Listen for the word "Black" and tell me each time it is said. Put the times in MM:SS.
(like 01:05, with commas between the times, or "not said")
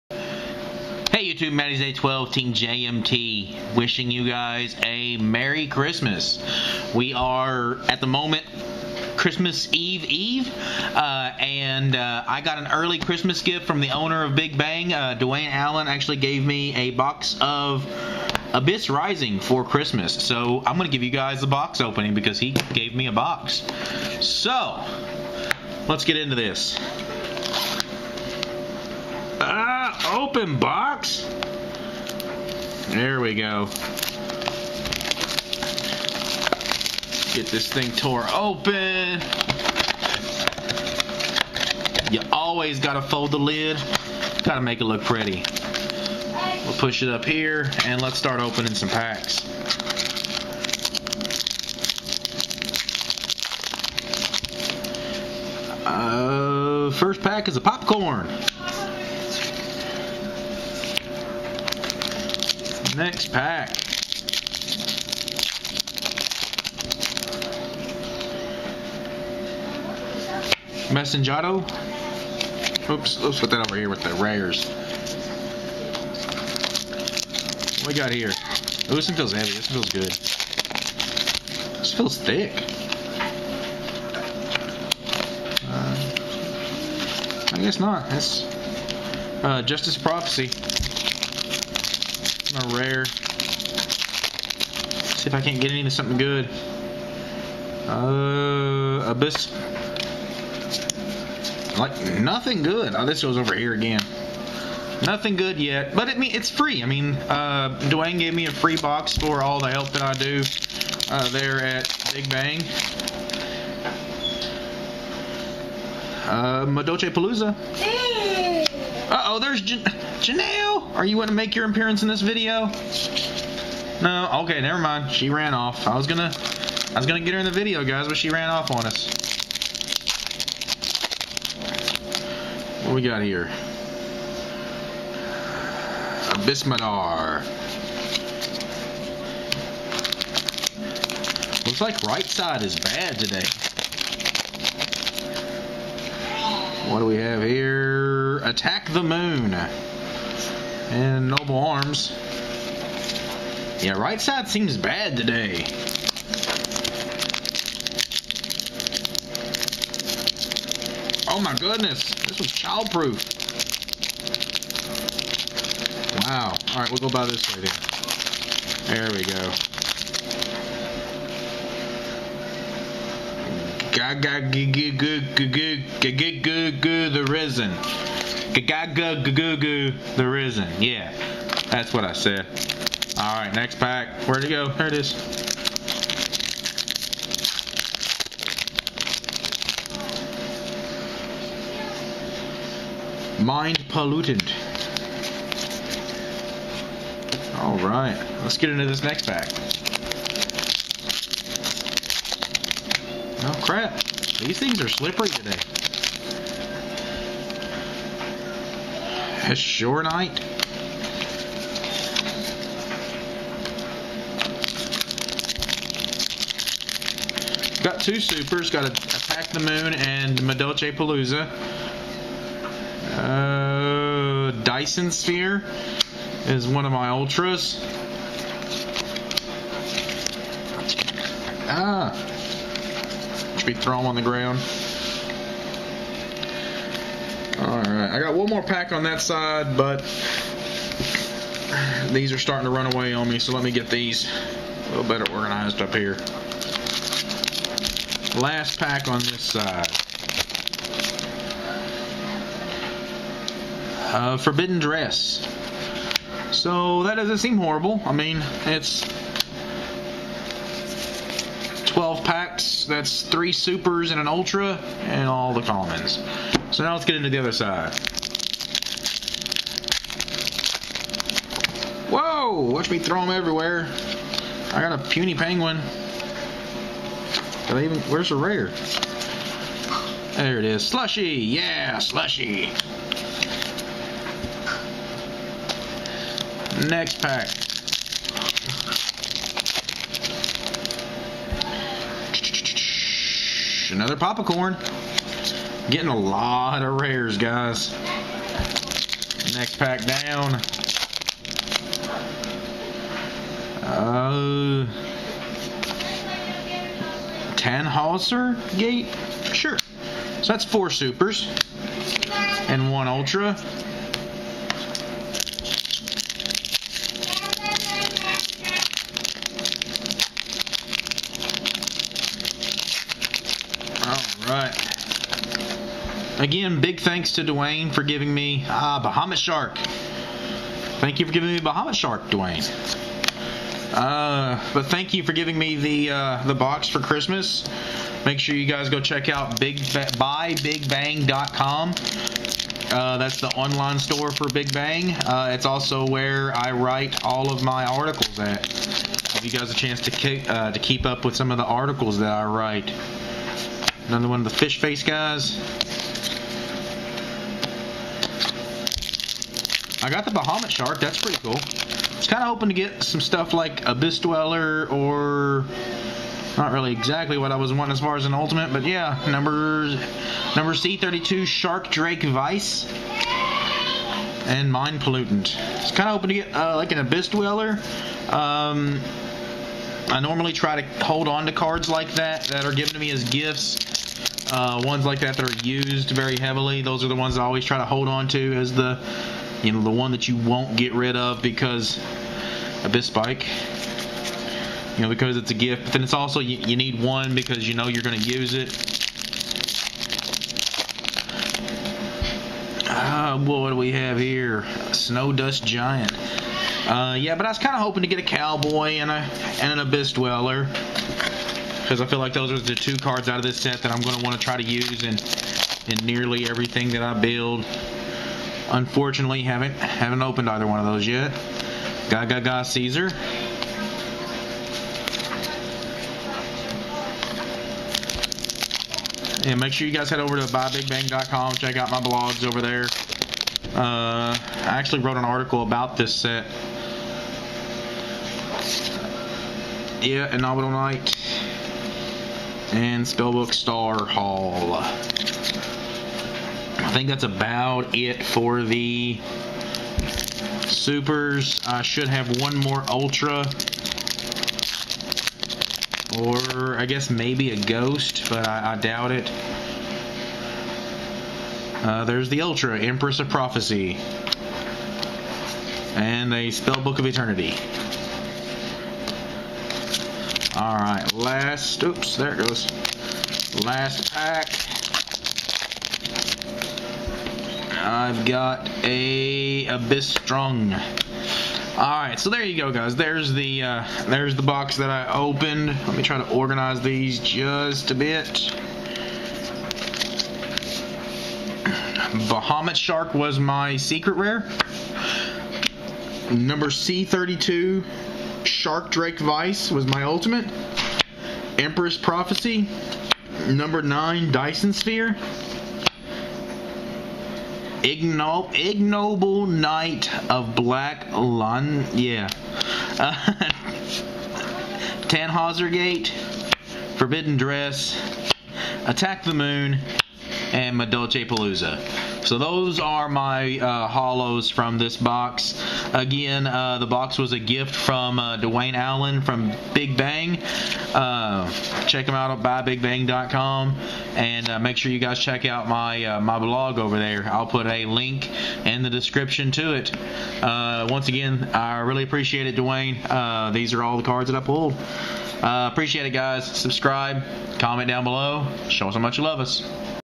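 08:30.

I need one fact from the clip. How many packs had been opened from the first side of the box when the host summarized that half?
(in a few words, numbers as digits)
12.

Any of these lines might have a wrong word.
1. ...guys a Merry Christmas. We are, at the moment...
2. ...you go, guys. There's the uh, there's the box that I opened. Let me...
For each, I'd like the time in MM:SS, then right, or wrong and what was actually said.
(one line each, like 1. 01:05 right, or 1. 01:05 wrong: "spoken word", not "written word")
1. 00:04 right
2. 08:02 right.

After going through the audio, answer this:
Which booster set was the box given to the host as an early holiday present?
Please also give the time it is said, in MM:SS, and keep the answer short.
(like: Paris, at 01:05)
Abyss Rising, at 00:18.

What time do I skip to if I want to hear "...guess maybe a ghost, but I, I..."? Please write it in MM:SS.
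07:36.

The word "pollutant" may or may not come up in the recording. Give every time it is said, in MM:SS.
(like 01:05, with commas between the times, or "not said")
03:13, 06:14.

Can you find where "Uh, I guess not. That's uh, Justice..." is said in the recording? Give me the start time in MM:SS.
01:25.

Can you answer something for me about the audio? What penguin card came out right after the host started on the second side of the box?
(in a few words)
puny penguin.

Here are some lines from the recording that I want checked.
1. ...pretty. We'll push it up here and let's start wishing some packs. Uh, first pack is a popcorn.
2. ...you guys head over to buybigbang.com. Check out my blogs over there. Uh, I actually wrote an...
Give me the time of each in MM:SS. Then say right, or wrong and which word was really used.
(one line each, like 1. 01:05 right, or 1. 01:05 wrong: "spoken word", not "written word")
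1. 00:45 wrong: "opening", not "wishing"
2. 07:09 right.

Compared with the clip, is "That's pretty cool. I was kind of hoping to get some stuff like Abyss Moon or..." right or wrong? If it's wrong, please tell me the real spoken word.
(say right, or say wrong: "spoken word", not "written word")
wrong: "Dweller", not "Moon".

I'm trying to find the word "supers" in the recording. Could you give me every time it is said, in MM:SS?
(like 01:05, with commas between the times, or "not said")
03:38, 04:23, 05:10, 07:30.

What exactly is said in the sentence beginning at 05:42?
Uh, that's the online store for Big Bang.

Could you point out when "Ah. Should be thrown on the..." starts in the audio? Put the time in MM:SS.
03:51.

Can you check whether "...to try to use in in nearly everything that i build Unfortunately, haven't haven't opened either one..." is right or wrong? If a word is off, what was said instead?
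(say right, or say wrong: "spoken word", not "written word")
right.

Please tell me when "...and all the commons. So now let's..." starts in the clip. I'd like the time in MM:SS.
04:25.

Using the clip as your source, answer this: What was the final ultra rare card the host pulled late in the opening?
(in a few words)
Empress of Prophecy.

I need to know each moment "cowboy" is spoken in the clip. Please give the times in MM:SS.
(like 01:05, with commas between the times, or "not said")
06:48.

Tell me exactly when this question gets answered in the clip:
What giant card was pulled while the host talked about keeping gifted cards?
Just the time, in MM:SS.
06:44.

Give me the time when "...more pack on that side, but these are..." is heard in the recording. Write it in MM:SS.
03:58.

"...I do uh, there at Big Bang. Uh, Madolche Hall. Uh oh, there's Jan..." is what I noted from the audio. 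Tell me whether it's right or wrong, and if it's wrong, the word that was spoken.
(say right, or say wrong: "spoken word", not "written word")
wrong: "Palooza", not "Hall".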